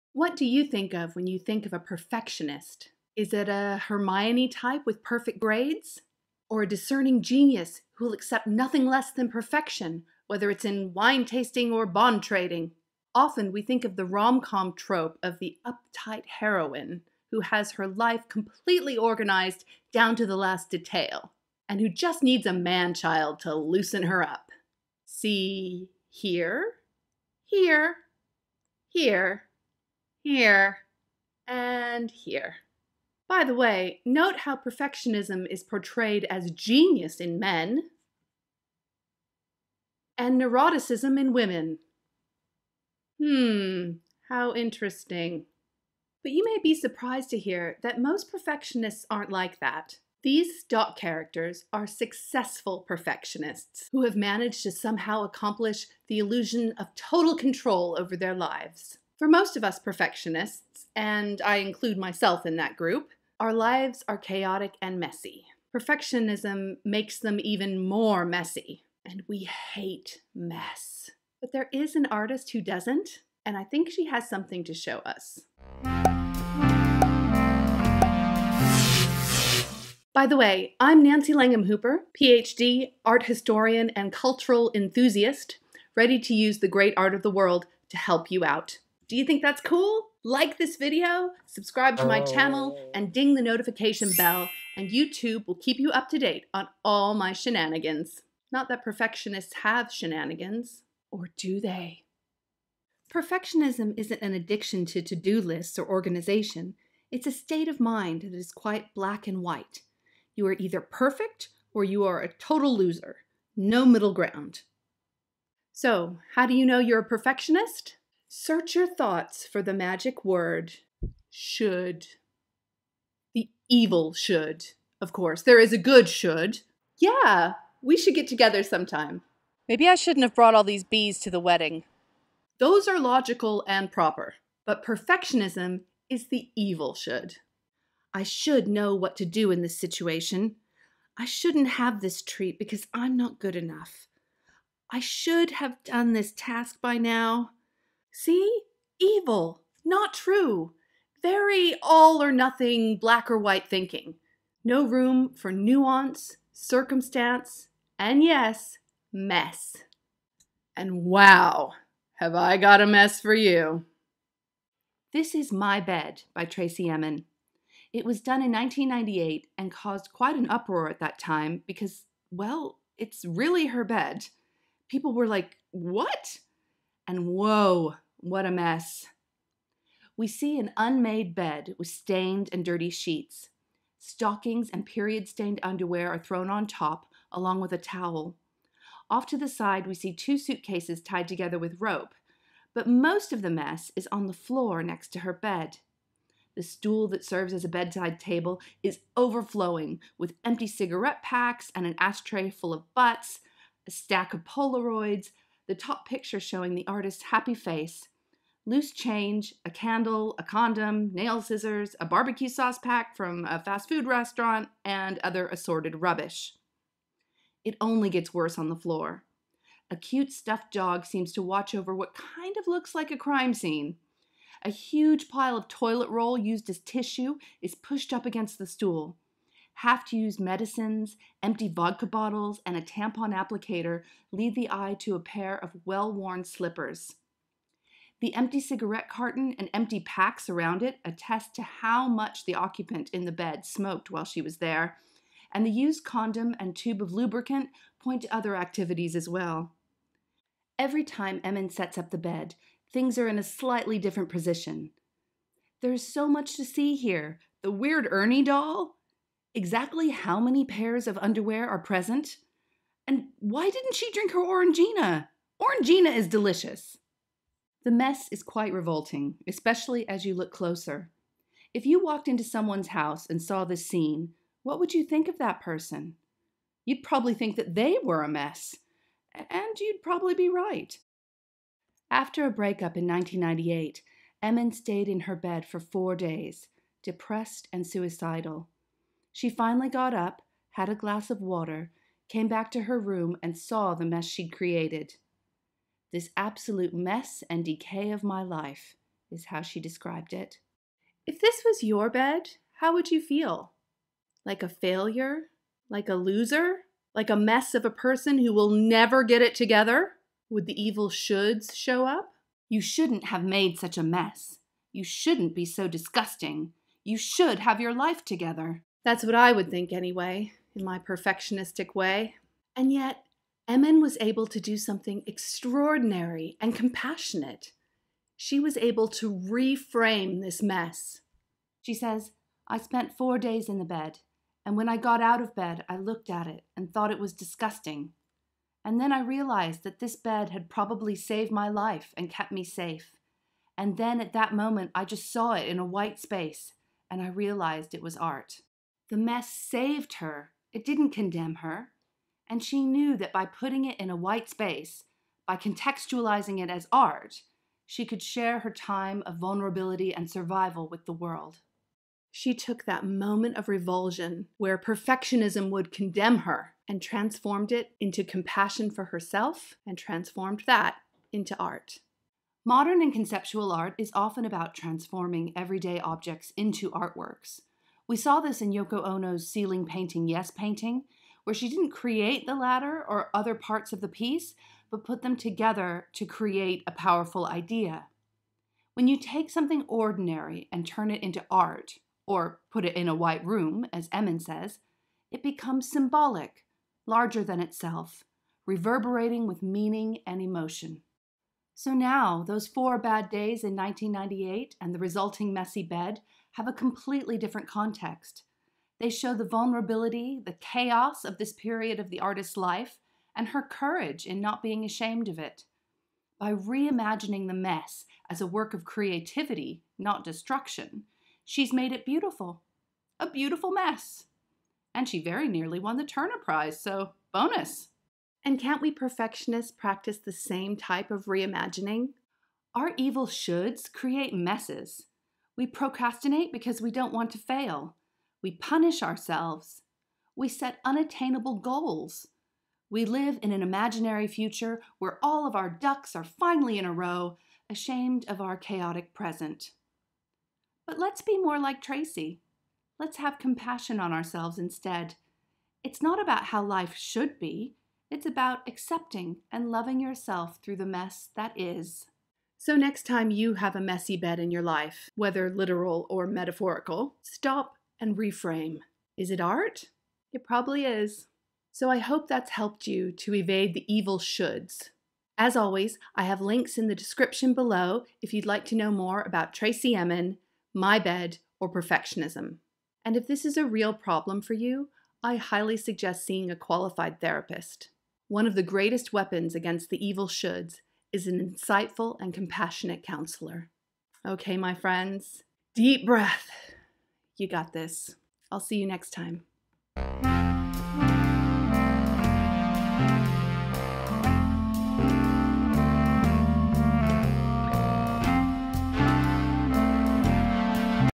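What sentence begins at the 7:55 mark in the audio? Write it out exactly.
As always, I have links in the description below if you'd like to know more about Tracey Emin, My Bed, or perfectionism.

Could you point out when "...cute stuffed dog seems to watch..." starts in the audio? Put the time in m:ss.
3:39.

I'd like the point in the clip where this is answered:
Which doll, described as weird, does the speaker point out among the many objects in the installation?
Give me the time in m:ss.
4:18.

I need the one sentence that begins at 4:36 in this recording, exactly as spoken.
You'd probably think that they were a mess, and you'd probably be right.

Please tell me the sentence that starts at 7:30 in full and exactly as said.
But let's be more like Tracey.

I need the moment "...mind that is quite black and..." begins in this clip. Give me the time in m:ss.
1:47.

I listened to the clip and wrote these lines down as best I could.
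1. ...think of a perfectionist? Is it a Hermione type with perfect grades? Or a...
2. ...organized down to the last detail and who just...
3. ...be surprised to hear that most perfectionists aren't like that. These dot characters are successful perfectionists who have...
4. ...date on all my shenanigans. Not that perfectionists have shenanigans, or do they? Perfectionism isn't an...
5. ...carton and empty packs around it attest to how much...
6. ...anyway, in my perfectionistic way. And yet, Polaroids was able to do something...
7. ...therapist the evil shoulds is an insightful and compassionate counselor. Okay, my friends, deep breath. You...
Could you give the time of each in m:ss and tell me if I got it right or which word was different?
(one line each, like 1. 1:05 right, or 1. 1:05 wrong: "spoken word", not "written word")
1. 0:01 right
2. 0:18 right
3. 0:46 right
4. 1:36 right
5. 3:59 right
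6. 5:19 wrong: "Emin", not "Polaroids"
7. 8:09 wrong: "against", not "therapist".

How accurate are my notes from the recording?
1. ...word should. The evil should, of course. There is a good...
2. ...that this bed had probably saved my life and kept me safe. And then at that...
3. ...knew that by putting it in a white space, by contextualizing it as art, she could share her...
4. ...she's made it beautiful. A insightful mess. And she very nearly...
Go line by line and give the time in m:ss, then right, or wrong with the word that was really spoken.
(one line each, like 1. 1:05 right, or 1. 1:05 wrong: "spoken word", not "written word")
1. 2:00 right
2. 5:39 right
3. 5:52 right
4. 7:01 wrong: "beautiful", not "insightful".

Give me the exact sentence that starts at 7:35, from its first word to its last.
It's not about how life should be, it's about accepting and loving yourself through the mess that is.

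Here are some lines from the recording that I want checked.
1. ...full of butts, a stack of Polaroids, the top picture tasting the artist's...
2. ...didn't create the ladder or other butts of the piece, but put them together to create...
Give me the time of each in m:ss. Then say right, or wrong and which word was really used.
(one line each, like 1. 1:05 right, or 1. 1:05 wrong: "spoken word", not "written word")
1. 3:22 wrong: "showing", not "tasting"
2. 6:21 wrong: "parts", not "butts".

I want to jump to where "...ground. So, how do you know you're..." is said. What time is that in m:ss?
1:54.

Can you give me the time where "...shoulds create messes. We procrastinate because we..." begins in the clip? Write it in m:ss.
7:13.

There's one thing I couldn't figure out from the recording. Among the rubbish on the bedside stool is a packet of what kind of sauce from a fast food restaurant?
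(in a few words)
Barbecue sauce.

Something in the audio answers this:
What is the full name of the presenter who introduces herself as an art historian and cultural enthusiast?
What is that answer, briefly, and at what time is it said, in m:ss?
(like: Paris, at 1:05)
Nancy Langham Hooper, at 1:21.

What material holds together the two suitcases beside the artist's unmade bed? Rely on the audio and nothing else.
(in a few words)
Rope.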